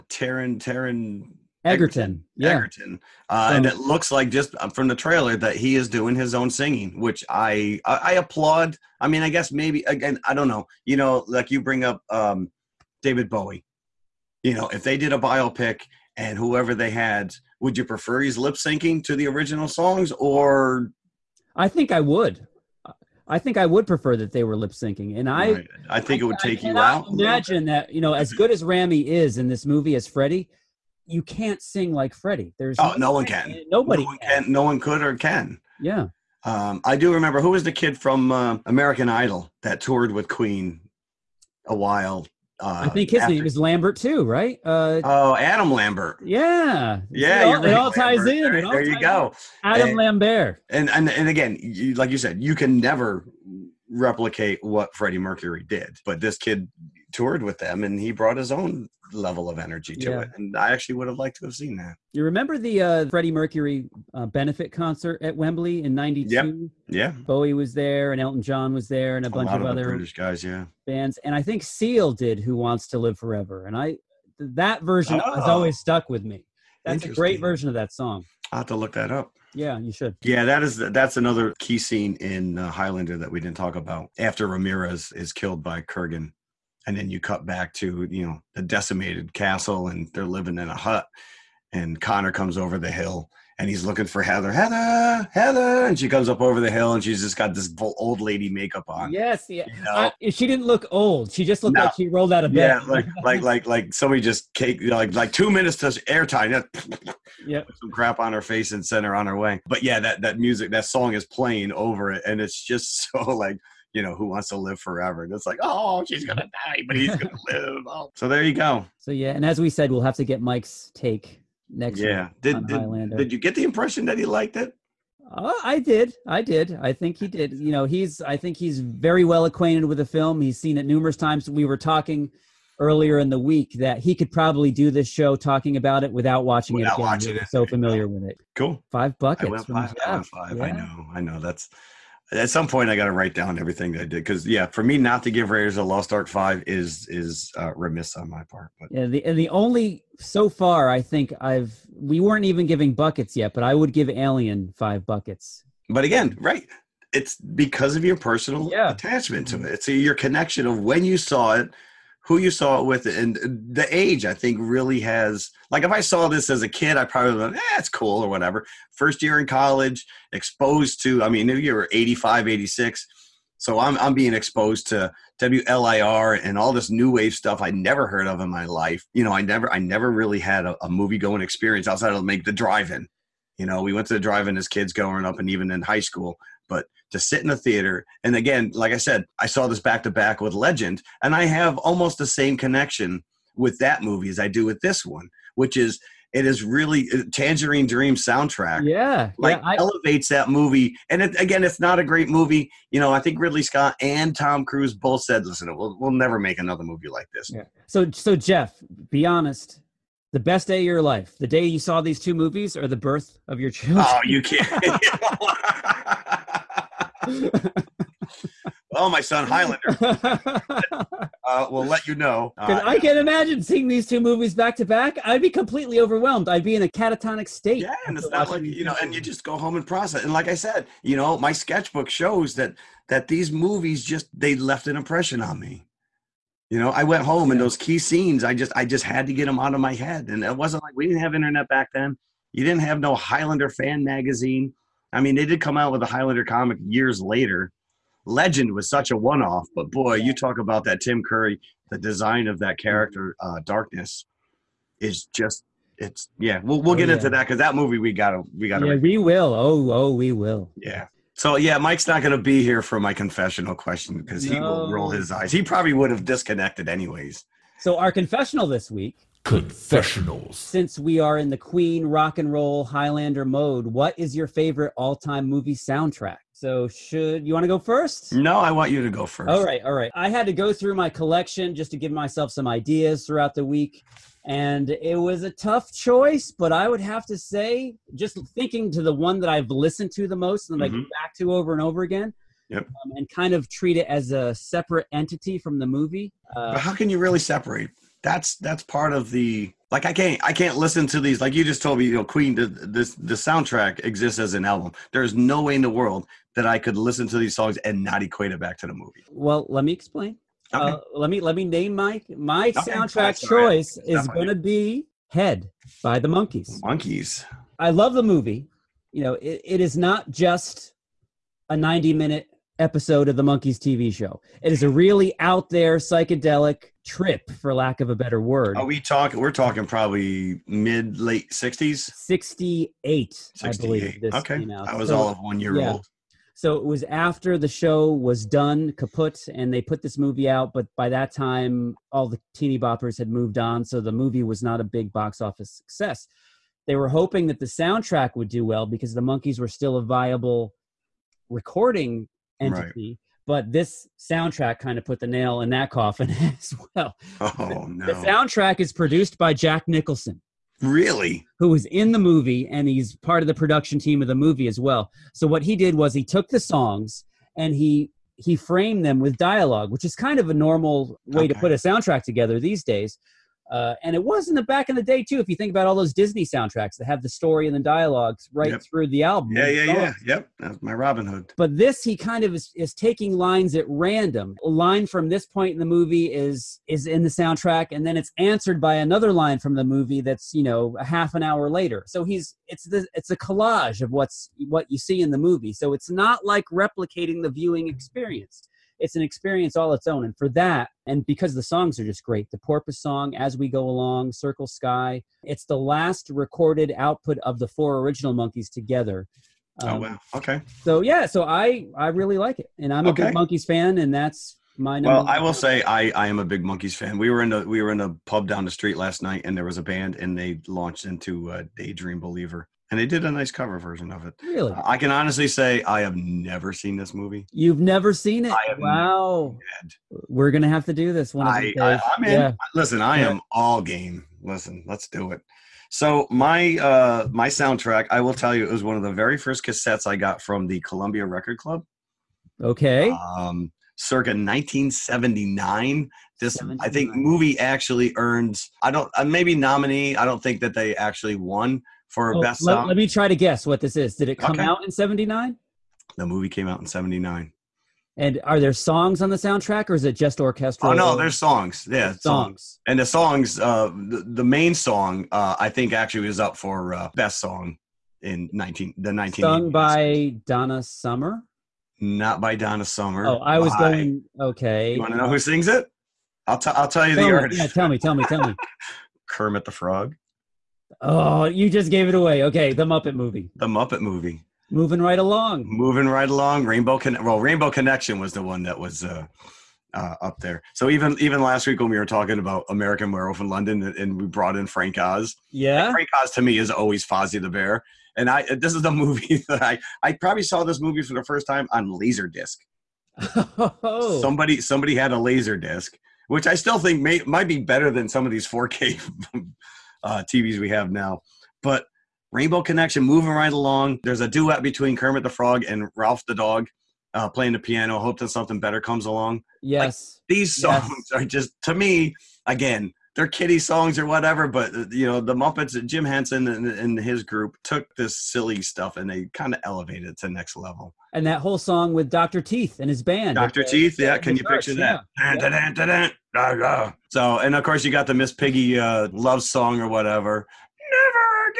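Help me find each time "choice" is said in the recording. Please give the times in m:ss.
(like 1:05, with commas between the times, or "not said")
4:45, 5:13.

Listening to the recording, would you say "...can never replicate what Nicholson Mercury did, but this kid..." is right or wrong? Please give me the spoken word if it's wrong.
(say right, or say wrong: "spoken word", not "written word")
wrong: "Freddie", not "Nicholson".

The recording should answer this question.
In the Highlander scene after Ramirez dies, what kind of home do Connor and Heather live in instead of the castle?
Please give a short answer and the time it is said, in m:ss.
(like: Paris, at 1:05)
a hut, at 1:30.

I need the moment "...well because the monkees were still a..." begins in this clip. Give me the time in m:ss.
5:48.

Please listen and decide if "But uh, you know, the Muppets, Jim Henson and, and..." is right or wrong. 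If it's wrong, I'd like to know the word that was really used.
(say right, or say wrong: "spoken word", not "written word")
right.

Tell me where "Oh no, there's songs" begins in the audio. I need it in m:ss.
7:40.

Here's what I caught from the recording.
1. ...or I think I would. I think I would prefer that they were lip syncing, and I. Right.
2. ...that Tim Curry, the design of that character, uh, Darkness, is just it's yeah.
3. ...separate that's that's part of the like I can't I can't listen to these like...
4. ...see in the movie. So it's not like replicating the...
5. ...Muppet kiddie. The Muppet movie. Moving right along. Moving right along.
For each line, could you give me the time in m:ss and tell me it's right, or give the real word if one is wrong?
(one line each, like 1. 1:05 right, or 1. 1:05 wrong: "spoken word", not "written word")
1. 0:20 right
2. 4:10 right
3. 4:57 right
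4. 6:34 right
5. 8:02 wrong: "movie", not "kiddie".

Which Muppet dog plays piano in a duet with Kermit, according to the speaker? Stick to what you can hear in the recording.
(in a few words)
Ralph the Dog.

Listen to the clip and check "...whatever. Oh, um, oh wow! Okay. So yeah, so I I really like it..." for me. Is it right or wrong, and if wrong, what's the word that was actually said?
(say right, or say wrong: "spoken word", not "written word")
wrong: "together", not "whatever".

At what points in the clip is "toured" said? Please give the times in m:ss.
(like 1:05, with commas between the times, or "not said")
0:39, 0:57.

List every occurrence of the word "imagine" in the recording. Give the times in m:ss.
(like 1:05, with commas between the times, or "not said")
0:27, 3:43.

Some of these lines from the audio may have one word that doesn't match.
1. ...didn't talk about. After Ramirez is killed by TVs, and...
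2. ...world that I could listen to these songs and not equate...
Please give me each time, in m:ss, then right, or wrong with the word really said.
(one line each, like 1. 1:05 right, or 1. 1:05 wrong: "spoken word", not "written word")
1. 1:23 wrong: "Kurgan", not "TVs"
2. 5:05 right.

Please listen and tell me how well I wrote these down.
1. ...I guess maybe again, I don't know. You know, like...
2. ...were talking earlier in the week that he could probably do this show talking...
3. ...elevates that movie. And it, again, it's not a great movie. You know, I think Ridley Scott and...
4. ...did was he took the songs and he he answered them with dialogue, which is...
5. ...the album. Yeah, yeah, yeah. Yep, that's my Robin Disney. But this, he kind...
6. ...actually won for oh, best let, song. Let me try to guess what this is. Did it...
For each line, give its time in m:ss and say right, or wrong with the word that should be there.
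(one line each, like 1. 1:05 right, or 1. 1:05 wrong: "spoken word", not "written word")
1. 0:09 right
2. 2:11 right
3. 3:19 right
4. 6:05 wrong: "framed", not "answered"
5. 6:19 wrong: "Hood", not "Disney"
6. 7:30 right.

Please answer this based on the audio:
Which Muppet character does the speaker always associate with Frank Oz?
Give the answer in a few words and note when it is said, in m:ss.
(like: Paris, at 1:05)
Fozzie the Bear, at 8:17.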